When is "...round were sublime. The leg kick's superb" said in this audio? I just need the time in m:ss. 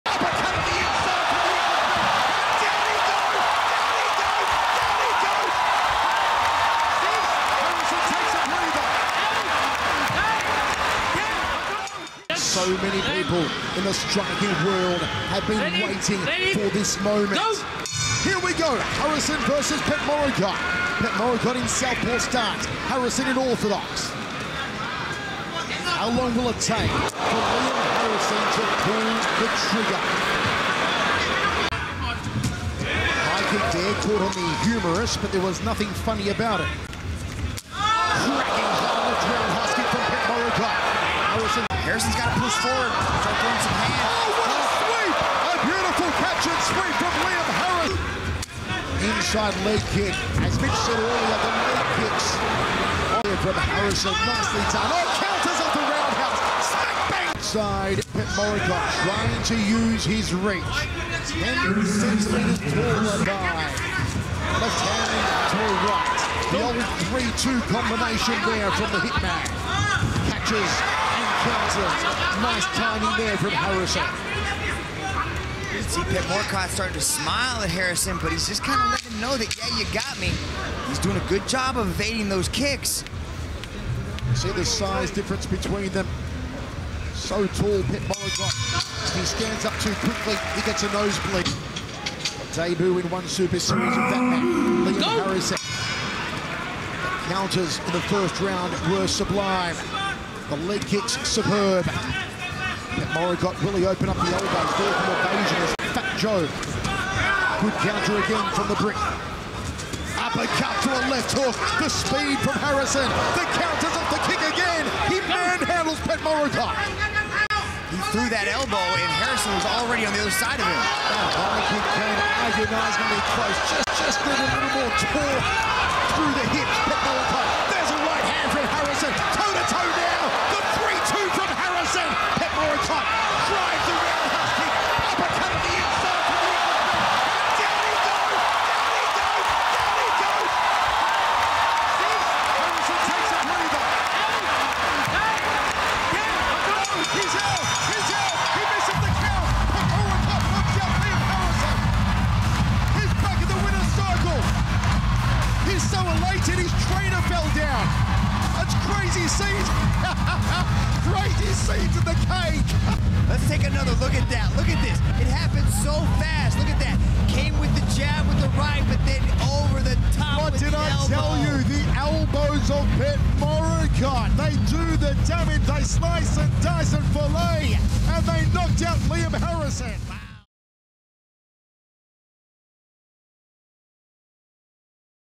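1:38.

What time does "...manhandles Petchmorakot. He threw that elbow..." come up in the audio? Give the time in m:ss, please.
1:55.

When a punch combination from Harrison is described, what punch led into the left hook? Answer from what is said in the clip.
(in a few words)
Uppercut.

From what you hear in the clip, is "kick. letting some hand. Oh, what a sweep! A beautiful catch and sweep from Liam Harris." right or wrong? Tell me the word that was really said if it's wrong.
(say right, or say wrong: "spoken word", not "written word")
wrong: "throwing", not "letting".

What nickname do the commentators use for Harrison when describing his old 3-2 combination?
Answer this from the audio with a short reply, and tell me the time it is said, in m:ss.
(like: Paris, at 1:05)
the hitman, at 1:08.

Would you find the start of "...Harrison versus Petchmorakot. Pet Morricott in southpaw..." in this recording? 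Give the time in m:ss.
0:18.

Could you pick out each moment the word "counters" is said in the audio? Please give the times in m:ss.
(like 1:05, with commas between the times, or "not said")
0:55, 1:11, 1:37, 1:47, 1:53.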